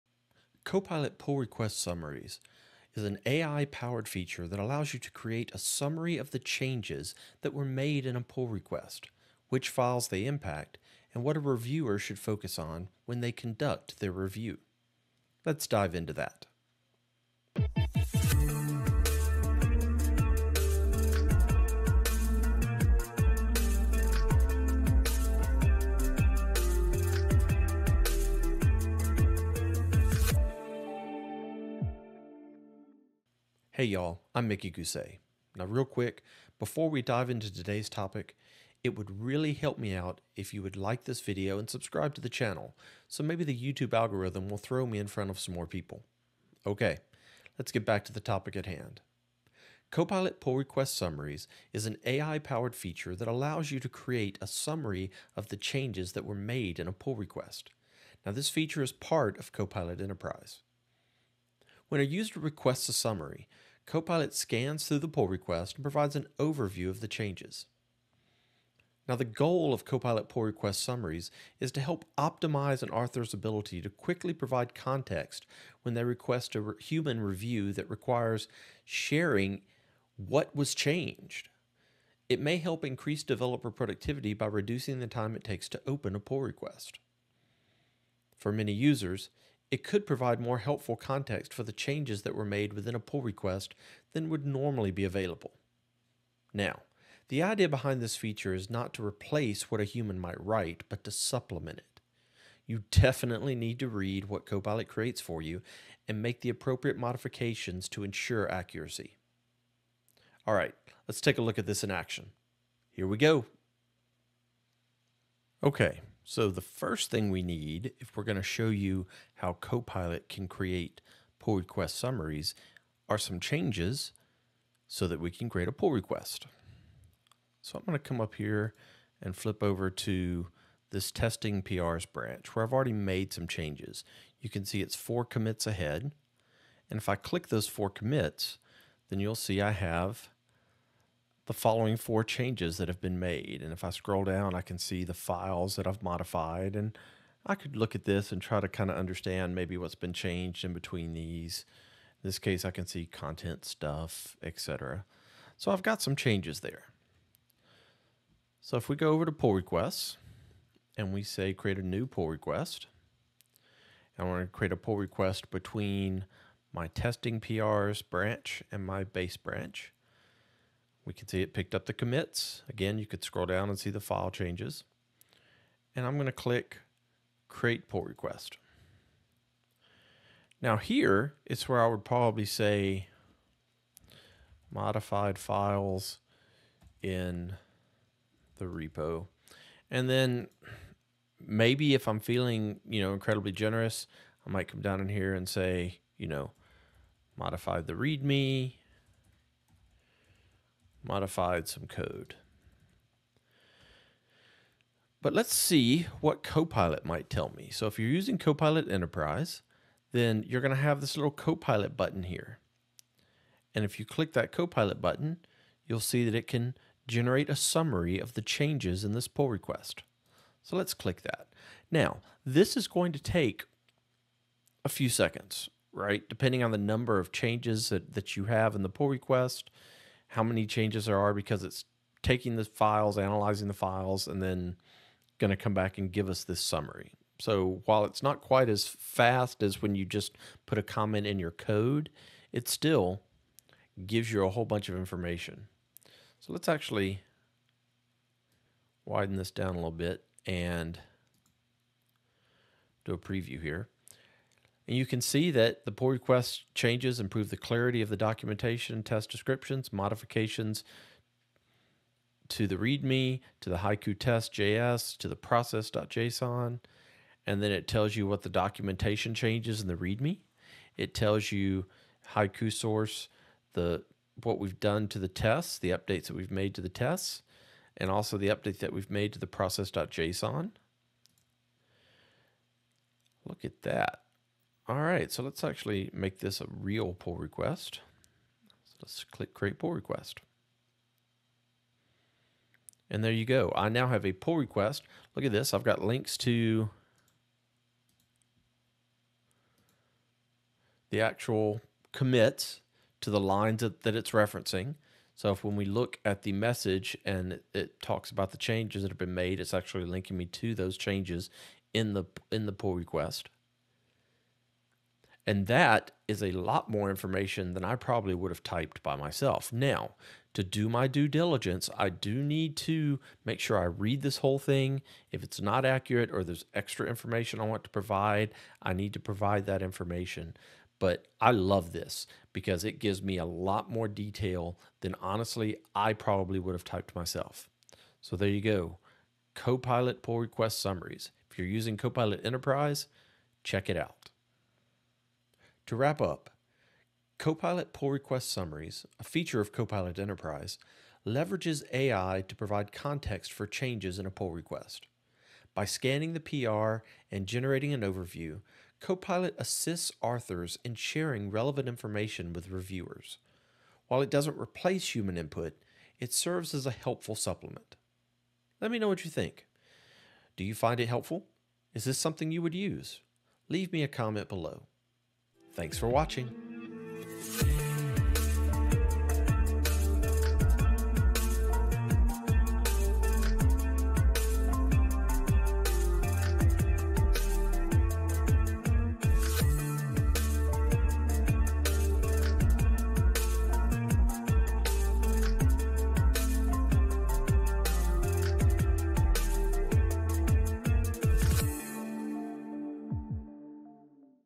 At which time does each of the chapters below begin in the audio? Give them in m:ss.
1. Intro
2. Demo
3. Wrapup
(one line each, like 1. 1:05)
1. 0:34
2. 1:54
3. 5:45.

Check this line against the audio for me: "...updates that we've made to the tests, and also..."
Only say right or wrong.
right.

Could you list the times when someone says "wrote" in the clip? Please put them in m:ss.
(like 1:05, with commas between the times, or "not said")
not said.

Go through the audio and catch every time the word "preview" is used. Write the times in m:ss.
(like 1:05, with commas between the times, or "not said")
4:13.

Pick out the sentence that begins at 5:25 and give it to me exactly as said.
If it's not accurate or there's extra information I want to provide, I need to provide that information.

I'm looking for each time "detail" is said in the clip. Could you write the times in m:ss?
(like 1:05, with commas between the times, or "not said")
5:34.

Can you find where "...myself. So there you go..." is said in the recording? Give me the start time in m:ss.
5:37.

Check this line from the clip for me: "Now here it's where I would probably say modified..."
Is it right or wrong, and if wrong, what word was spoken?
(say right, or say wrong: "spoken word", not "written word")
right.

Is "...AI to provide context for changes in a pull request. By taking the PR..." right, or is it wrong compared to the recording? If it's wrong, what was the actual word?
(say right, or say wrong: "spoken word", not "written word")
wrong: "scanning", not "taking".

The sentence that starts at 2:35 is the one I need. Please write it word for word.
So I've got some changes there.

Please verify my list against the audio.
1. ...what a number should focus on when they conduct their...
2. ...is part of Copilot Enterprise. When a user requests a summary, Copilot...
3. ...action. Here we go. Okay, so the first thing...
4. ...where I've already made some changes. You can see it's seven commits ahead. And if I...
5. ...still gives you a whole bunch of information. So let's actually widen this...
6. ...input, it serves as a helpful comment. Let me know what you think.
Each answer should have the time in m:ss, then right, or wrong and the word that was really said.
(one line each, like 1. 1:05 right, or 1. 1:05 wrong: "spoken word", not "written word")
1. 0:11 wrong: "reviewer", not "number"
2. 0:58 right
3. 1:51 right
4. 2:12 wrong: "four", not "seven"
5. 4:02 right
6. 6:05 wrong: "supplement", not "comment".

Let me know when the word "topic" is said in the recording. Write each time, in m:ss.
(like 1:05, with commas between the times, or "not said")
0:37, 0:48.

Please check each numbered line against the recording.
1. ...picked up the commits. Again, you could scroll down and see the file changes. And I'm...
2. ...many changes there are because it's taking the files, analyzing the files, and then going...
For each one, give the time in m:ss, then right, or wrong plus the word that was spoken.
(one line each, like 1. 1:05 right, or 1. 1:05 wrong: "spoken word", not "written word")
1. 2:51 right
2. 3:50 right.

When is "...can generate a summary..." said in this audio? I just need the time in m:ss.
3:36.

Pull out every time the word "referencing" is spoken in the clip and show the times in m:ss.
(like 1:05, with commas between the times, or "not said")
5:04.